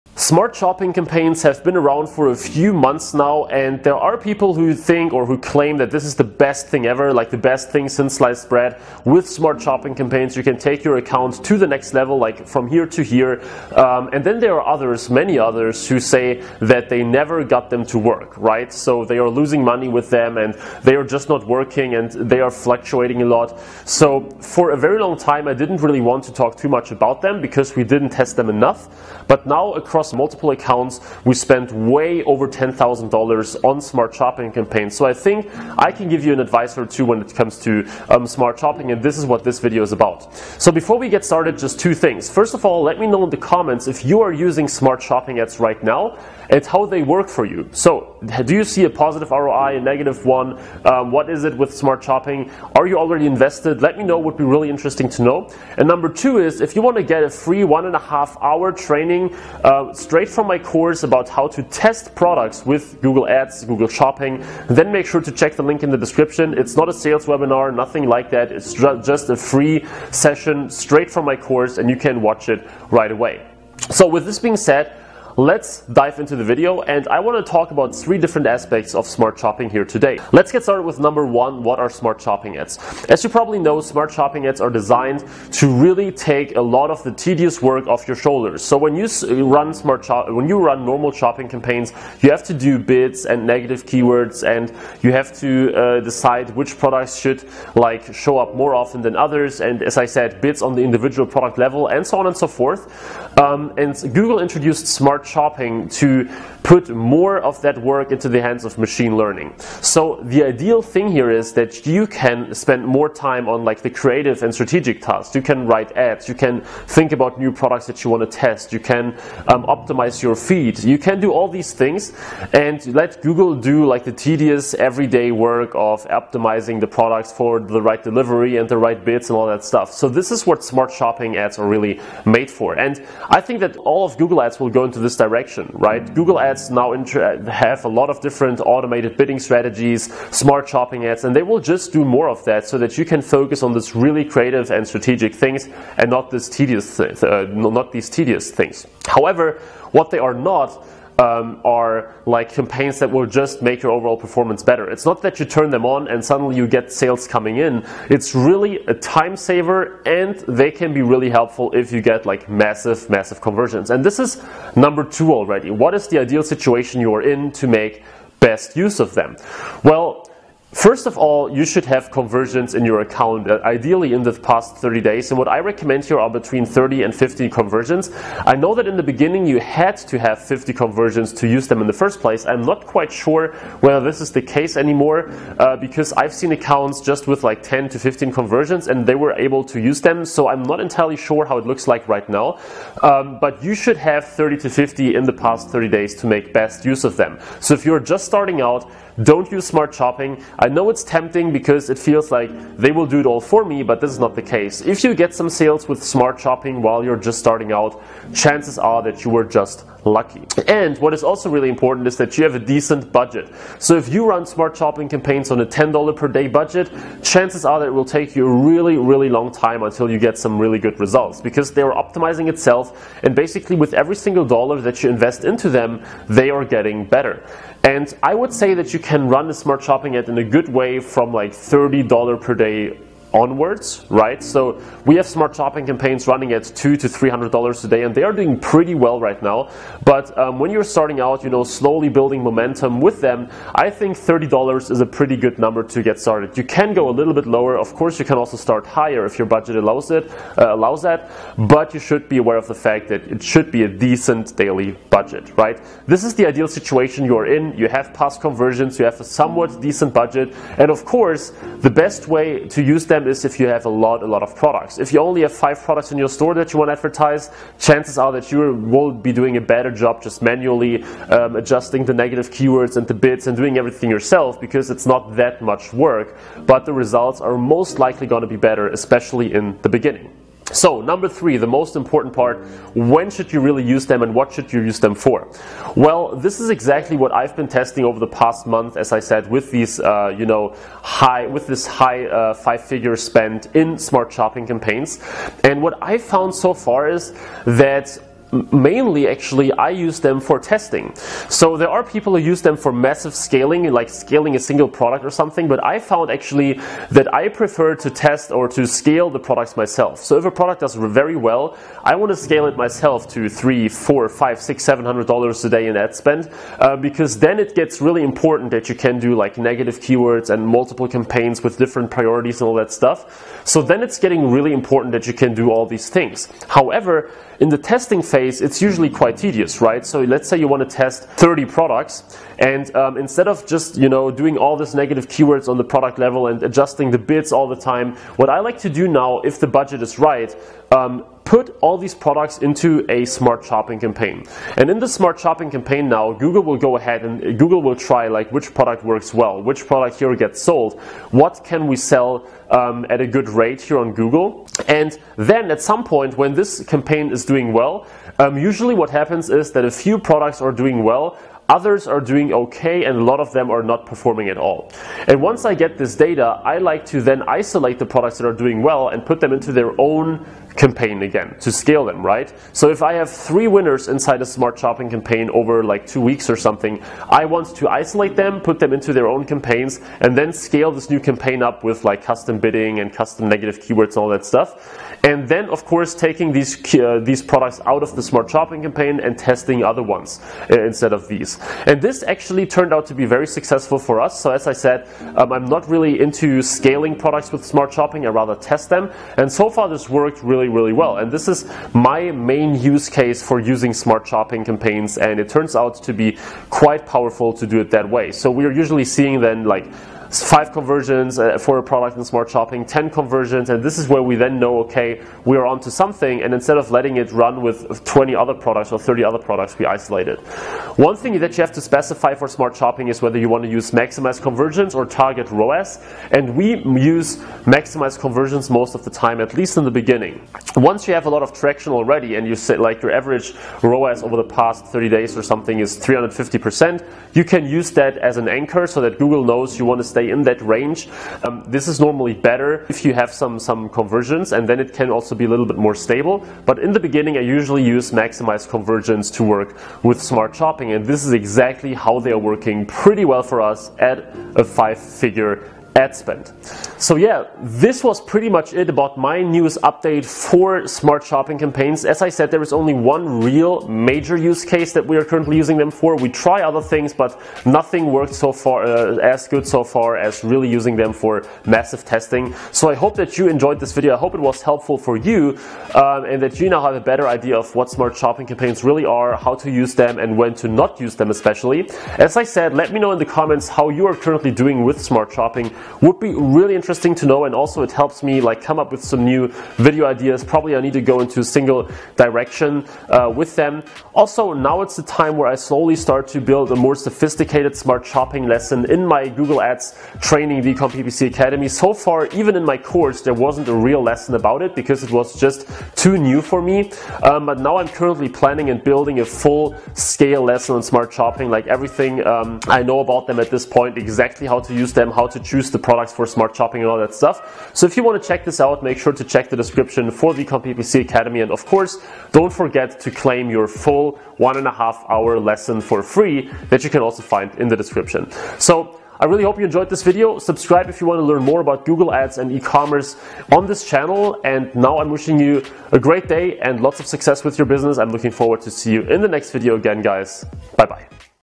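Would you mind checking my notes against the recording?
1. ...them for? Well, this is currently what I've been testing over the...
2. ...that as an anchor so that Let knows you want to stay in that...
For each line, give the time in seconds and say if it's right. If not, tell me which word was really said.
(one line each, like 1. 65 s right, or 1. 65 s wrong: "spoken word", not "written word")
1. 284 s wrong: "exactly", not "currently"
2. 437 s wrong: "Google", not "Let".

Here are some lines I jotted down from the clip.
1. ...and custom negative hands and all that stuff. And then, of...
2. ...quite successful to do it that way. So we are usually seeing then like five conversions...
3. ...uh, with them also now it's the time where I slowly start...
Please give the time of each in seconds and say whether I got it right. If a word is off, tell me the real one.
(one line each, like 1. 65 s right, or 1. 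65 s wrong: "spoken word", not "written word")
1. 382 s wrong: "keywords", not "hands"
2. 406 s wrong: "powerful", not "successful"
3. 493 s right.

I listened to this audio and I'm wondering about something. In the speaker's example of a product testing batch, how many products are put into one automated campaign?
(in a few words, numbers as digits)
30.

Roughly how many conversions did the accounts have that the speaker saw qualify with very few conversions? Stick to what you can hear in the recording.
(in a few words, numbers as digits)
10 to 15.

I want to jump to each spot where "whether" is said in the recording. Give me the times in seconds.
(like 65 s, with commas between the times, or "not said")
183 s, 423 s.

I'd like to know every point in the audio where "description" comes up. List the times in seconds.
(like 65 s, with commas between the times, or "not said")
65 s, 519 s, 527 s.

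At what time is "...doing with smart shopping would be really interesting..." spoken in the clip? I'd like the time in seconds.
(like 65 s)
484 s.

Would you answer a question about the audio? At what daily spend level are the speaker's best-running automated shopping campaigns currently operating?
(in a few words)
$200 to $300 a day.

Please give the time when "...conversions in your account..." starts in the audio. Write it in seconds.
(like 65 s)
172 s.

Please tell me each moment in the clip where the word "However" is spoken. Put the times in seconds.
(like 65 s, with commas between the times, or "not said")
149 s, 326 s.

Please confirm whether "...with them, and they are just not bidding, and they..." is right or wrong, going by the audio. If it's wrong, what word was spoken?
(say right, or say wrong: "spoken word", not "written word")
wrong: "working", not "bidding".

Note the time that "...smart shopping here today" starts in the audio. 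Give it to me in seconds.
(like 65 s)
79 s.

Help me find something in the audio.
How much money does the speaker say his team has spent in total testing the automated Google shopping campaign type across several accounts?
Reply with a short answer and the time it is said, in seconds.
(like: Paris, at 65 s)
over $10,000, at 31 s.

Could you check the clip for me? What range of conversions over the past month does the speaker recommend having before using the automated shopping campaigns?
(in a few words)
30 to 50.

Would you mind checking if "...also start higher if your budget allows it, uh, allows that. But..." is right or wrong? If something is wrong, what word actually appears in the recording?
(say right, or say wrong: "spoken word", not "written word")
right.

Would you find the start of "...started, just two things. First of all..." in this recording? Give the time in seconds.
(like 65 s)
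41 s.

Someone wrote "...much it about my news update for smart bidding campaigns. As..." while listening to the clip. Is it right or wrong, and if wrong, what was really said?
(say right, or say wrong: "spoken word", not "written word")
wrong: "shopping", not "bidding".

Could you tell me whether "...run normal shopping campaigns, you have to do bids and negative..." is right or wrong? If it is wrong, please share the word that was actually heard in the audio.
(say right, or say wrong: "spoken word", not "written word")
right.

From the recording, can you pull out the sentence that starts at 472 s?
So I hope that you enjoyed this video.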